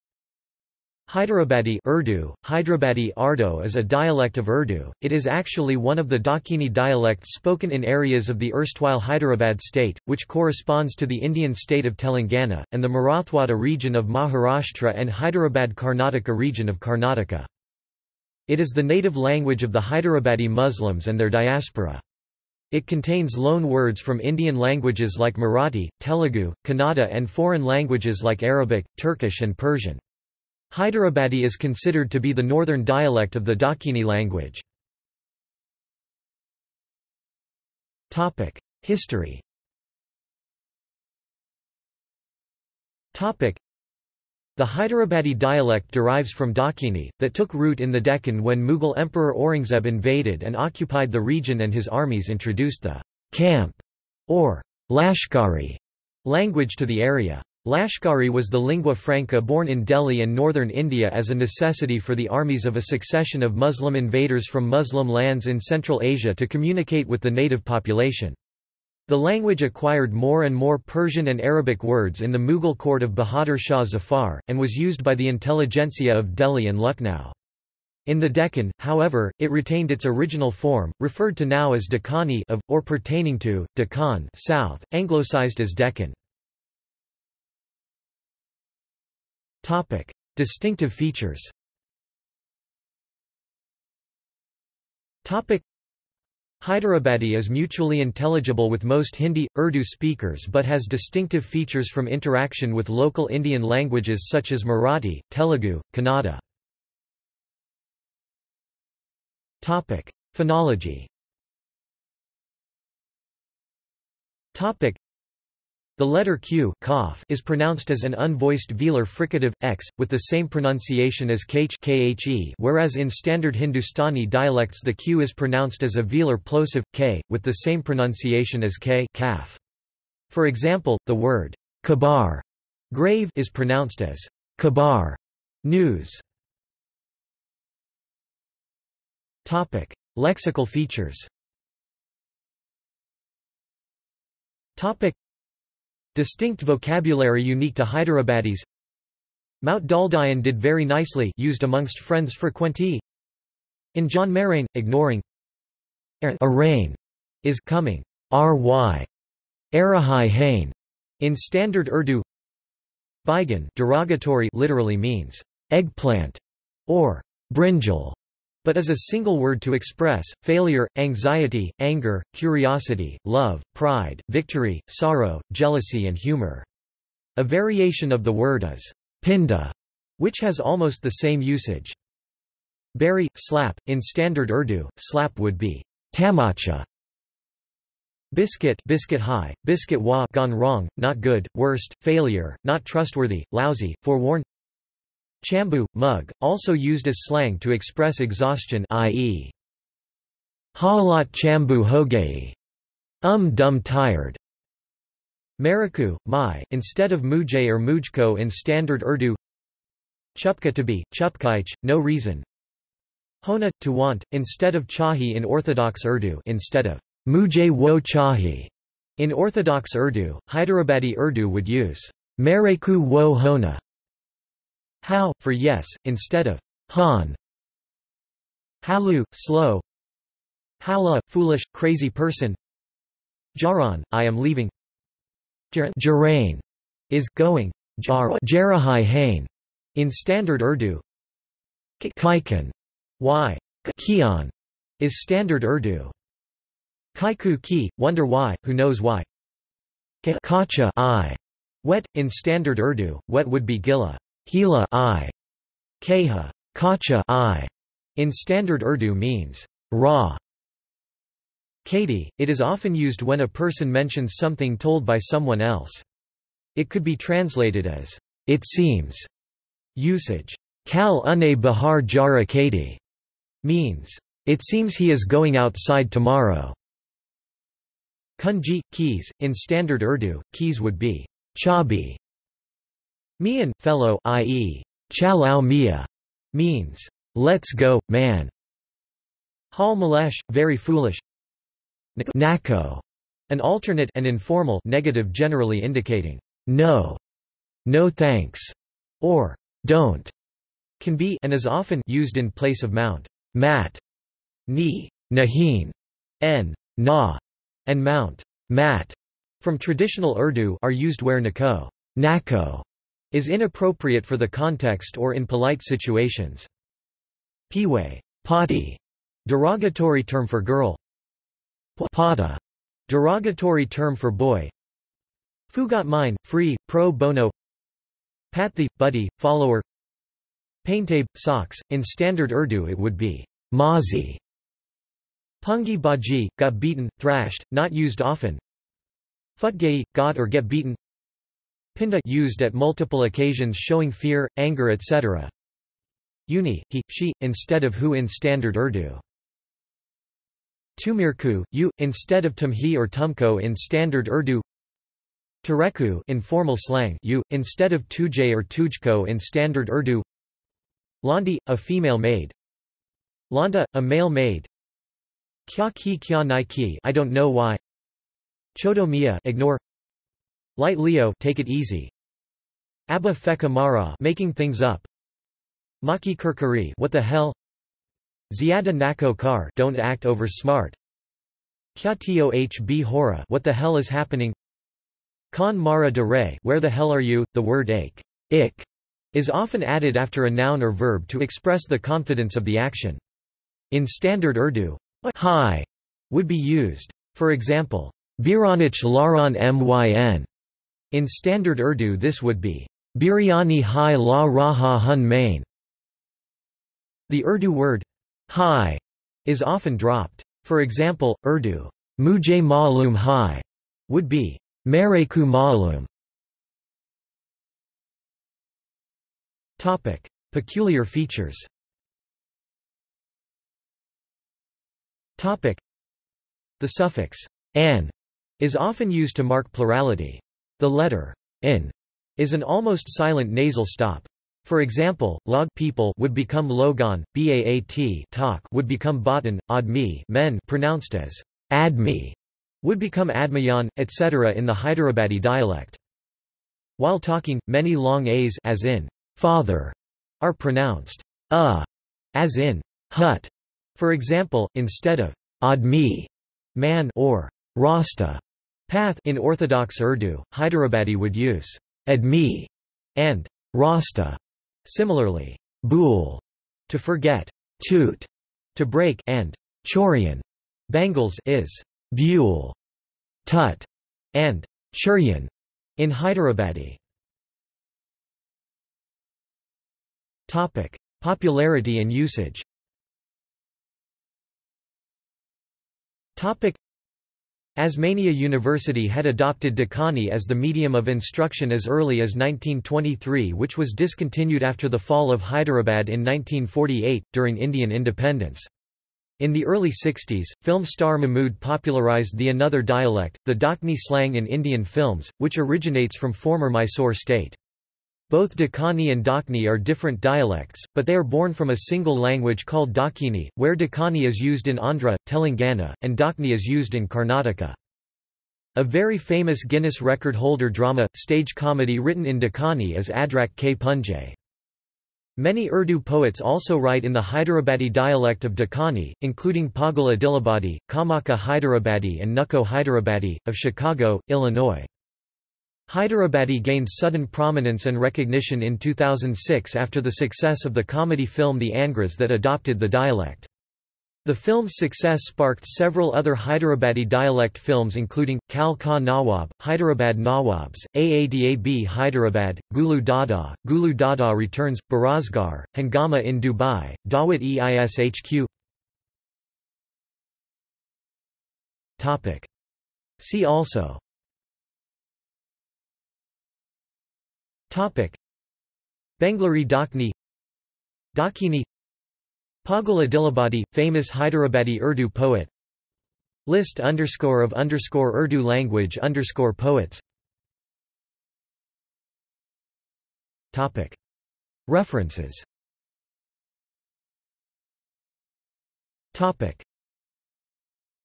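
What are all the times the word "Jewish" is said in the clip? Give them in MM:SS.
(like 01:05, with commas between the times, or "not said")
not said.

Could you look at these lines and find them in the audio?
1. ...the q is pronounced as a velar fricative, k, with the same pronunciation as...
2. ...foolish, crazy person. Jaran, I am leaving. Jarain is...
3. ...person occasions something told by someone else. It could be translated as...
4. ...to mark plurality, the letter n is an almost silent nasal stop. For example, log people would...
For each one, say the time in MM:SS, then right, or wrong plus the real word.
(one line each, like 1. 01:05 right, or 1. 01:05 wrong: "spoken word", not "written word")
1. 02:04 wrong: "plosive", not "fricative"
2. 03:51 right
3. 04:23 wrong: "mentions", not "occasions"
4. 07:09 right.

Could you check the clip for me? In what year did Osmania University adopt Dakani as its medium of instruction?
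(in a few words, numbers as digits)
1923.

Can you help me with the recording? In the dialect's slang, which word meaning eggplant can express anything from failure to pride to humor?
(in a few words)
Baigan.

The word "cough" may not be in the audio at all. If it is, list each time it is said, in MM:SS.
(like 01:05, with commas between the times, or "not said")
01:56.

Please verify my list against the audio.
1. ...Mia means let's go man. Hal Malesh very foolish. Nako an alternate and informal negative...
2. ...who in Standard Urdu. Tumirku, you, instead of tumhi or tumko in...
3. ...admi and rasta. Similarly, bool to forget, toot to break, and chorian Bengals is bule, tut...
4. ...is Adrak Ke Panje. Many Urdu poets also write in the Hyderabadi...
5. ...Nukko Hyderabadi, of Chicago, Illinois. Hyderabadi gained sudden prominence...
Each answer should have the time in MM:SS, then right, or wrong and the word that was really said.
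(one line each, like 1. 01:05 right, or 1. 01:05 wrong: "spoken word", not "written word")
1. 04:45 right
2. 05:47 right
3. 07:42 right
4. 08:42 right
5. 08:52 right.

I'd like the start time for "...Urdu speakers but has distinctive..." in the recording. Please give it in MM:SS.
01:39.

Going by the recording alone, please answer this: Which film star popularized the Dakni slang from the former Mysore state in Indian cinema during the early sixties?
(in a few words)
Mahmood.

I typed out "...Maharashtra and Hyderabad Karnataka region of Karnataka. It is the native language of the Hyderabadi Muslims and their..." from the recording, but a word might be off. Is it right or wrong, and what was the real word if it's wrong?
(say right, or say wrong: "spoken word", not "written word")
right.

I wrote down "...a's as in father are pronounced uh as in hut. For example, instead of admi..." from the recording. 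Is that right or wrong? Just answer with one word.
right.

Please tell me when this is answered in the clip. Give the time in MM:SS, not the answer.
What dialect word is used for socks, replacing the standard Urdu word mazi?
05:30.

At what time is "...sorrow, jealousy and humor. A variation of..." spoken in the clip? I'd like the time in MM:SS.
02:54.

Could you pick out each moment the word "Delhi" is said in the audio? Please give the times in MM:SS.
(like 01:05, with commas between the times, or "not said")
00:59, 01:16.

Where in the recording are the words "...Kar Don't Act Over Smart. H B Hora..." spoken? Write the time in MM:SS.
06:19.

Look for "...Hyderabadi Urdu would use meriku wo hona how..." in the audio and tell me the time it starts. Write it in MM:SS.
03:40.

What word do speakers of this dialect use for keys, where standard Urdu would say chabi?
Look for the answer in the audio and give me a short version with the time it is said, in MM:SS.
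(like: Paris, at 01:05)
Kunji, at 04:38.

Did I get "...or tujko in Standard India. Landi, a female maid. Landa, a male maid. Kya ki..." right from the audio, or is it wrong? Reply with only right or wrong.
wrong.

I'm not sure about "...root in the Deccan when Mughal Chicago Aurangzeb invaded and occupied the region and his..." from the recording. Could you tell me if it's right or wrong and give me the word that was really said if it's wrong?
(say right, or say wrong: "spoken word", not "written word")
wrong: "Emperor", not "Chicago".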